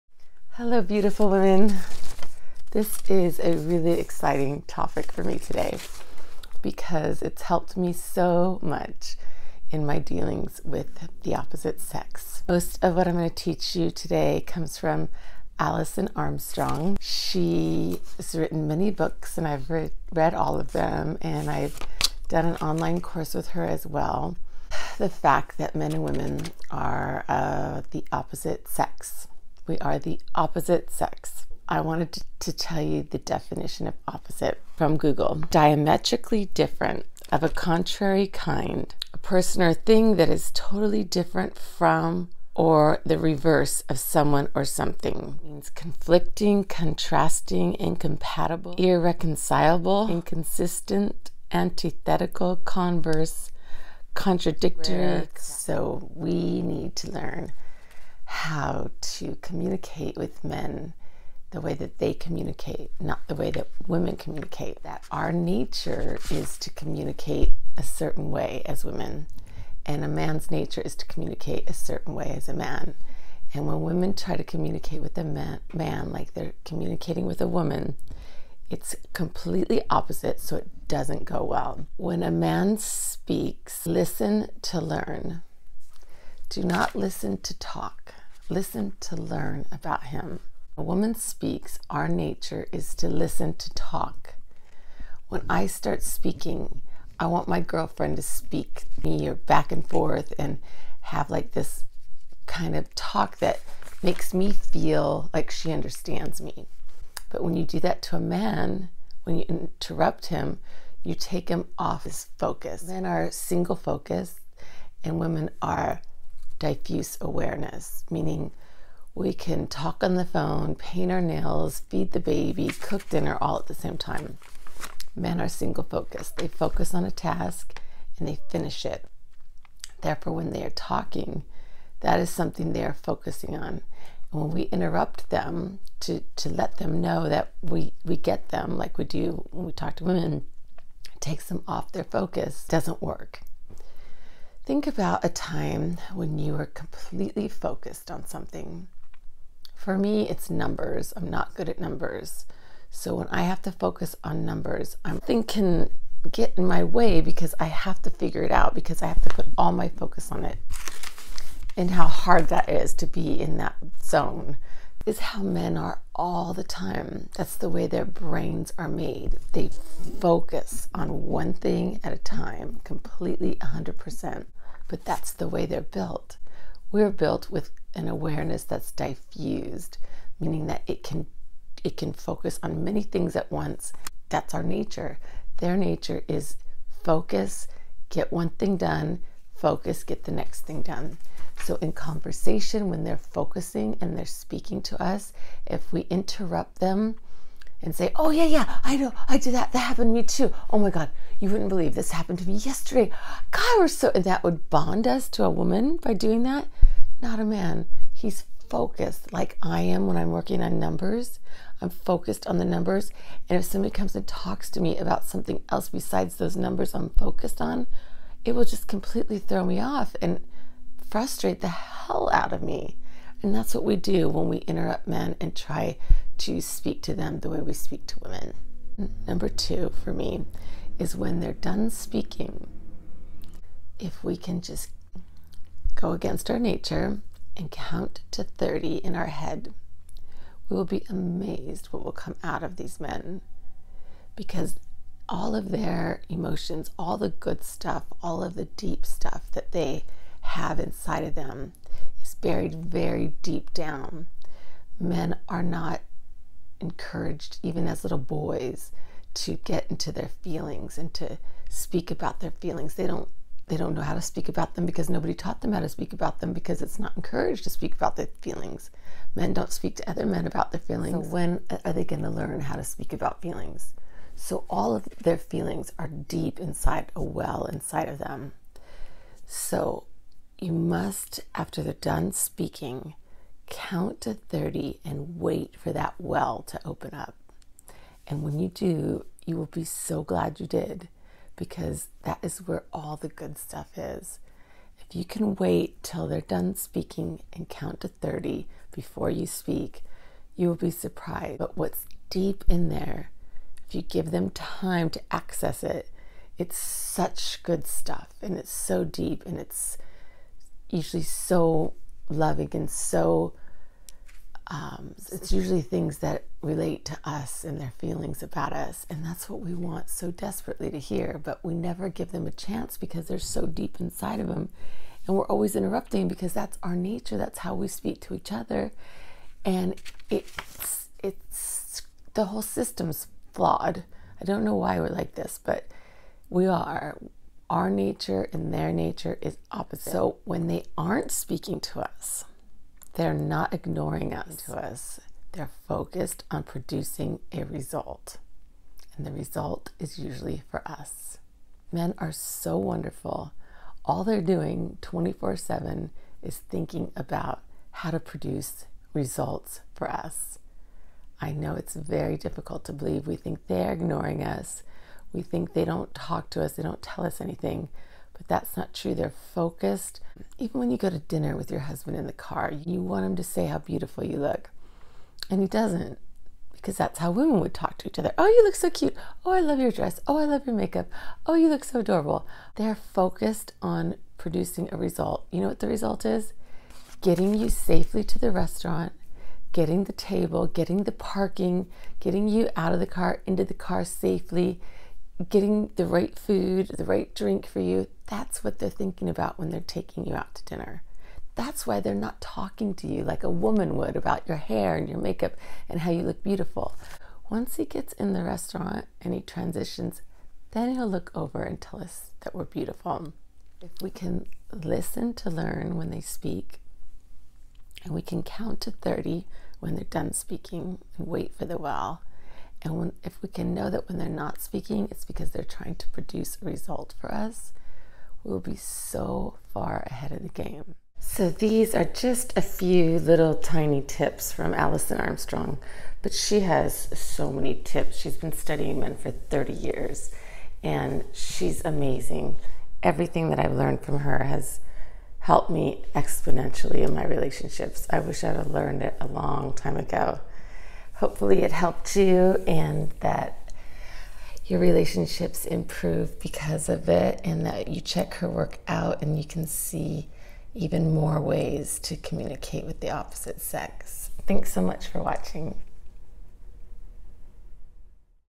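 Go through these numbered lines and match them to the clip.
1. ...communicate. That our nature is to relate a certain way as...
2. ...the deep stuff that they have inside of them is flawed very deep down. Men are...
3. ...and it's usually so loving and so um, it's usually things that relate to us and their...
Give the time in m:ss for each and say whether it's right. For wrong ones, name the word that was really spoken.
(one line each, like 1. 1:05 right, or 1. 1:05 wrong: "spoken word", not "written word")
1. 1:04 wrong: "communicate", not "relate"
2. 4:08 wrong: "buried", not "flawed"
3. 5:09 right.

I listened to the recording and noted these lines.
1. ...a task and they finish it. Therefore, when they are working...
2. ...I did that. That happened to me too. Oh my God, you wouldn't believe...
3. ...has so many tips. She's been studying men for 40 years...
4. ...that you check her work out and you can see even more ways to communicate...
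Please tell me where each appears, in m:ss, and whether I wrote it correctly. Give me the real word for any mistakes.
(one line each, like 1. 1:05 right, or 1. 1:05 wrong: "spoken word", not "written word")
1. 2:07 wrong: "talking", not "working"
2. 3:19 right
3. 7:16 wrong: "30", not "40"
4. 7:37 right.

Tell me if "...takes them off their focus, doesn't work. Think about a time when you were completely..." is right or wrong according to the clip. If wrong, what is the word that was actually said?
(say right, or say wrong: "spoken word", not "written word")
right.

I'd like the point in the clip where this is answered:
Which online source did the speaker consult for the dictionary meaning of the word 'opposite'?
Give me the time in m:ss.
0:34.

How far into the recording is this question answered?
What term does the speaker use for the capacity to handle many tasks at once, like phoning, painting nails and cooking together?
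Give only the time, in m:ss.
1:56.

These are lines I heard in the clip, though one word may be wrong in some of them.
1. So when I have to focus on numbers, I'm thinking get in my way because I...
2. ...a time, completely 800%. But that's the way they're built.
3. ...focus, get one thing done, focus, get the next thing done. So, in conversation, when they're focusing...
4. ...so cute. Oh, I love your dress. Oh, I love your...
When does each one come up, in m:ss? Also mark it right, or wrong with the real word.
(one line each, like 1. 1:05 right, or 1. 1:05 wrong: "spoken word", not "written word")
1. 2:32 right
2. 2:52 wrong: "100", not "800"
3. 3:07 right
4. 6:18 right.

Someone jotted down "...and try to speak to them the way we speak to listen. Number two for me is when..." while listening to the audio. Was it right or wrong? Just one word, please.
wrong.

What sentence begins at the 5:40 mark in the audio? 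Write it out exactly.
So when they aren't speaking to us, they're not ignoring us.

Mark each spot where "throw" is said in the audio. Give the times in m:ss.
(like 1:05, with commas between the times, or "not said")
3:39.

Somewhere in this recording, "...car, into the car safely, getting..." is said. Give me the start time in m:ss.
6:33.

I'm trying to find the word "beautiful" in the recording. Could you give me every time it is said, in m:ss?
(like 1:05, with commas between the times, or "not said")
0:00, 6:13, 6:46, 6:52.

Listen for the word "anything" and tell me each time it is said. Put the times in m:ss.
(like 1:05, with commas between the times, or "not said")
6:07.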